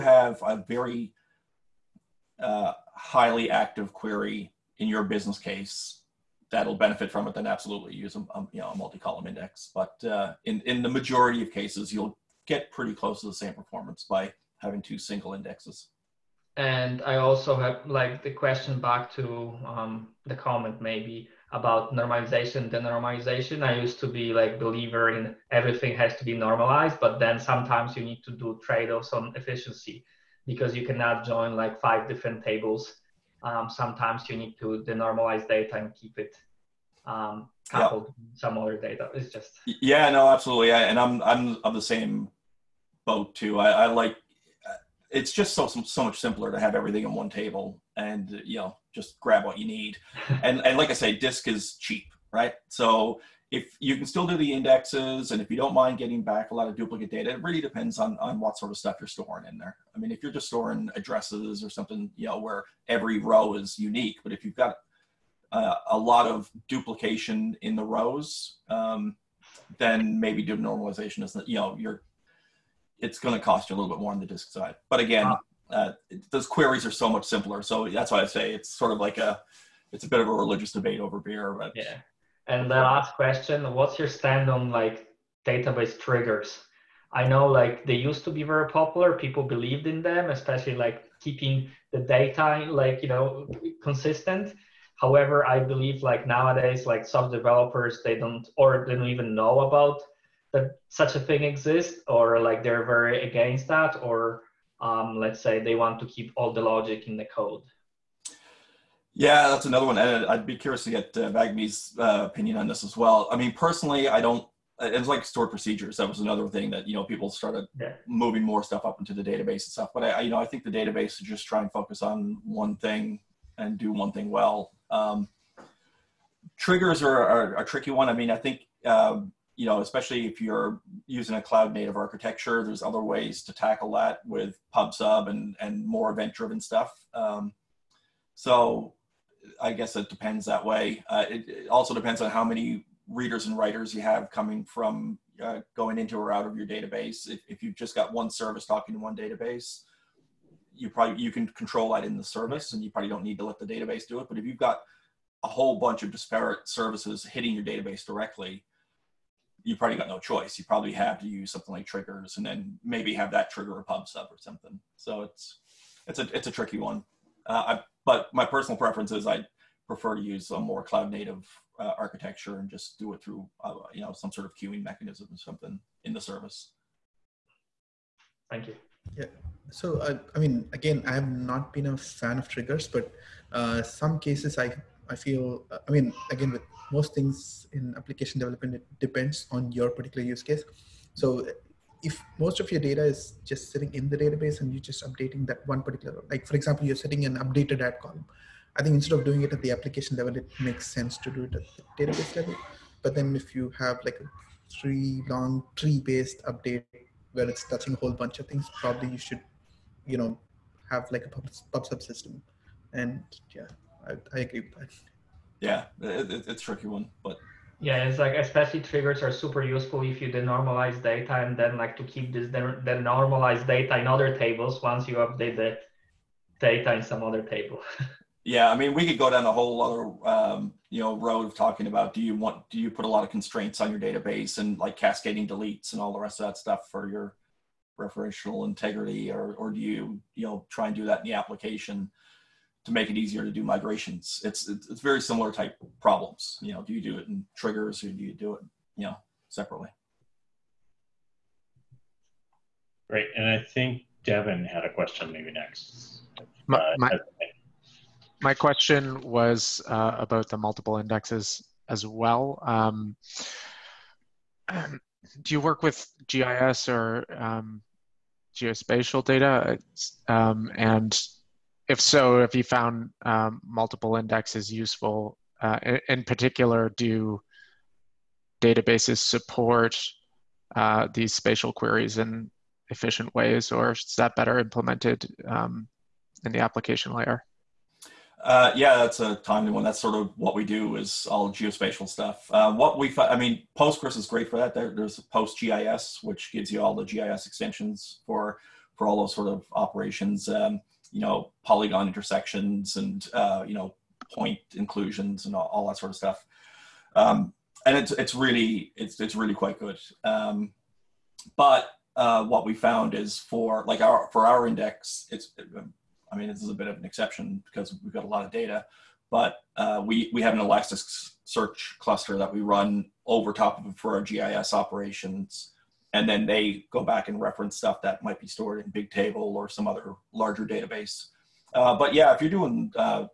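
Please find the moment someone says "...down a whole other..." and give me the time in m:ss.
3:49.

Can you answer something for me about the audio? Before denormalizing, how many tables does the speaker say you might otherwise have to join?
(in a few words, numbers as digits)
5.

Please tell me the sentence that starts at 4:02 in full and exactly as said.
to make it easier to do migrations.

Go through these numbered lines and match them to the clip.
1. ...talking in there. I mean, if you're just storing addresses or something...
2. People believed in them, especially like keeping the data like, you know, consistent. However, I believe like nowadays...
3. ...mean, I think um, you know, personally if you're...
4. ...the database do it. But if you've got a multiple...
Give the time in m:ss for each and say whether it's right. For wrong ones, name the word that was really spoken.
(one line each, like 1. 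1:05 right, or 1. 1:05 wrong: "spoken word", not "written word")
1. 0:59 wrong: "storing", not "talking"
2. 1:29 right
3. 2:08 wrong: "especially", not "personally"
4. 2:33 wrong: "whole", not "multiple".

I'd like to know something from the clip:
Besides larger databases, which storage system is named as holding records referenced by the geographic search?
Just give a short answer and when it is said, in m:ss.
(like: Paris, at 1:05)
Bigtable, at 5:28.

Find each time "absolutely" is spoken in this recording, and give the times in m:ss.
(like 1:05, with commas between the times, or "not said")
0:07, 0:40.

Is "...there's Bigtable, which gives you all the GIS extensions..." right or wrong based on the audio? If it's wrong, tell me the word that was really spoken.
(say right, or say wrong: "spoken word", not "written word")
wrong: "PostGIS", not "Bigtable".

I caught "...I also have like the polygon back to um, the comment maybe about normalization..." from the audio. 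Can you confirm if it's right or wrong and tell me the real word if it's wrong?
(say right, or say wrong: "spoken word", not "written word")
wrong: "question", not "polygon".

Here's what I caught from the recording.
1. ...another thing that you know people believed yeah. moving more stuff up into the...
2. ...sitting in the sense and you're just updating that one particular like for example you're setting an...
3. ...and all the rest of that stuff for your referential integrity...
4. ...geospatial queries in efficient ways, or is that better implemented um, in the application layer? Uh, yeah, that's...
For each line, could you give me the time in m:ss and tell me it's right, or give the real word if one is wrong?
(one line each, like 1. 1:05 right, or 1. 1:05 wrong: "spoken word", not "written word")
1. 1:56 wrong: "started", not "believed"
2. 3:13 wrong: "database", not "sense"
3. 3:55 right
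4. 4:41 wrong: "spatial", not "geospatial".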